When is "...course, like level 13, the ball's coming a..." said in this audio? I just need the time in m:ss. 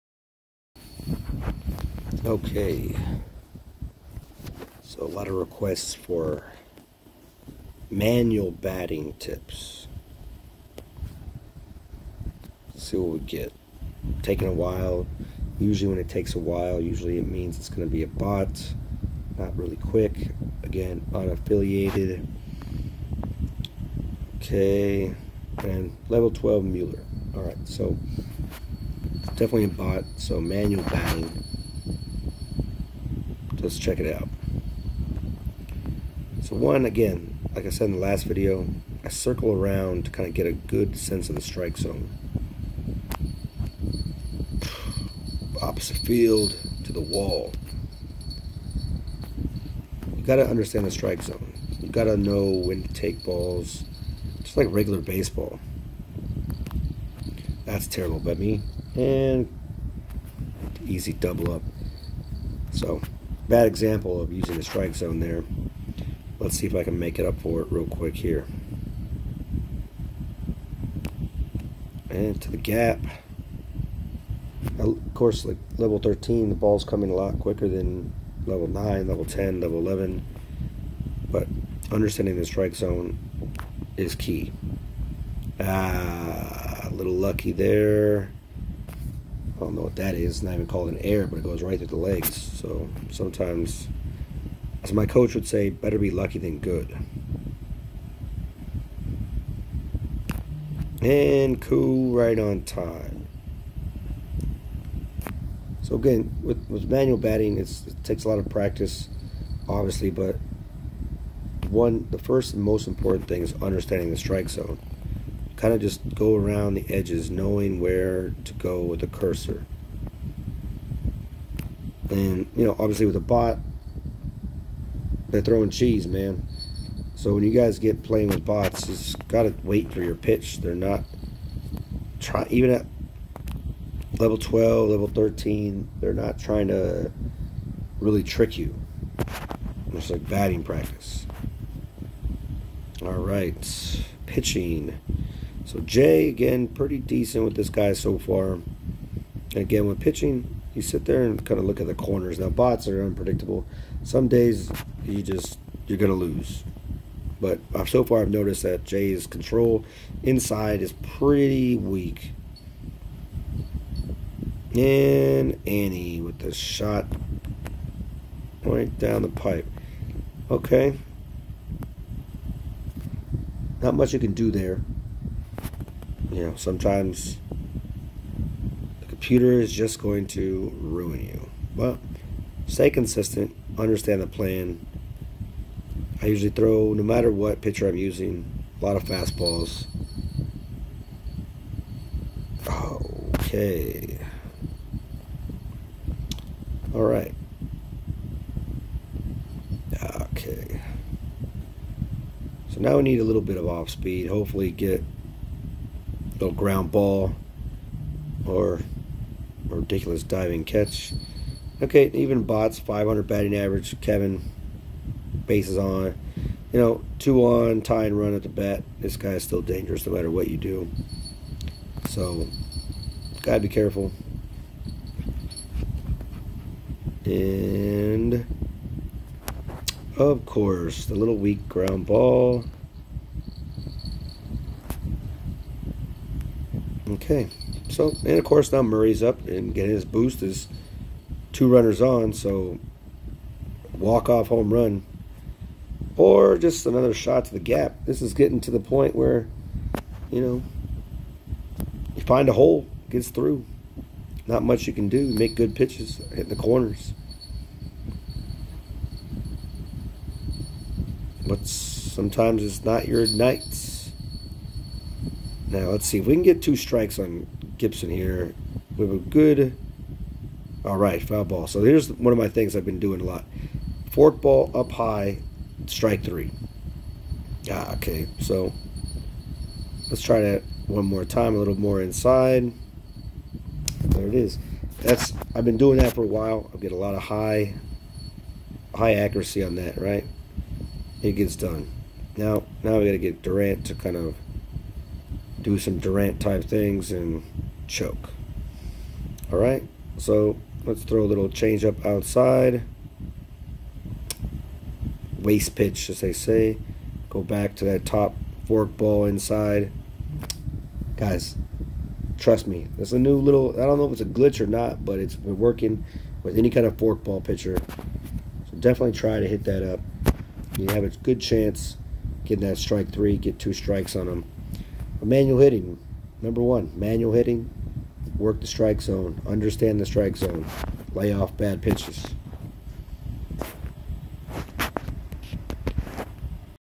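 1:15.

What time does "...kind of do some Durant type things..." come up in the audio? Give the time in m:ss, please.
4:53.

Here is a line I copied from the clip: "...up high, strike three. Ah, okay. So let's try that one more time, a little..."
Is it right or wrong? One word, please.
right.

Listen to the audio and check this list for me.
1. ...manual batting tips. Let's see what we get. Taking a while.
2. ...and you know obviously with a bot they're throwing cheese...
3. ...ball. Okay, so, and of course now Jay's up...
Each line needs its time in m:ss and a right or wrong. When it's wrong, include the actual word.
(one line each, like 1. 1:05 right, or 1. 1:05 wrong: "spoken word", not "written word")
1. 0:07 right
2. 2:02 right
3. 3:52 wrong: "Murray", not "Jay".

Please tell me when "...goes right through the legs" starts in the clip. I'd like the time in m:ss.
1:31.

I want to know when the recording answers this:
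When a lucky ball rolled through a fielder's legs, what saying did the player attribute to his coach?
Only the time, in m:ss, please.
1:35.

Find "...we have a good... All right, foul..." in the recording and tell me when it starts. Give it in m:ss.
4:28.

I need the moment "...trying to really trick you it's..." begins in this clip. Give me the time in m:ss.
2:16.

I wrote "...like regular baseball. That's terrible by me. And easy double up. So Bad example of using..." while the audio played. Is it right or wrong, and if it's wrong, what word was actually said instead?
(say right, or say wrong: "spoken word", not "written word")
right.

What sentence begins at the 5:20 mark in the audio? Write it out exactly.
You have a good chance getting that strike three, get two strikes on them.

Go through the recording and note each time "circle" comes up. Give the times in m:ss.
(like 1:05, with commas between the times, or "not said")
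0:39.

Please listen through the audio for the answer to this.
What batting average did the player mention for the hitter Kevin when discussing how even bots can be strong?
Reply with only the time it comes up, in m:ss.
3:32.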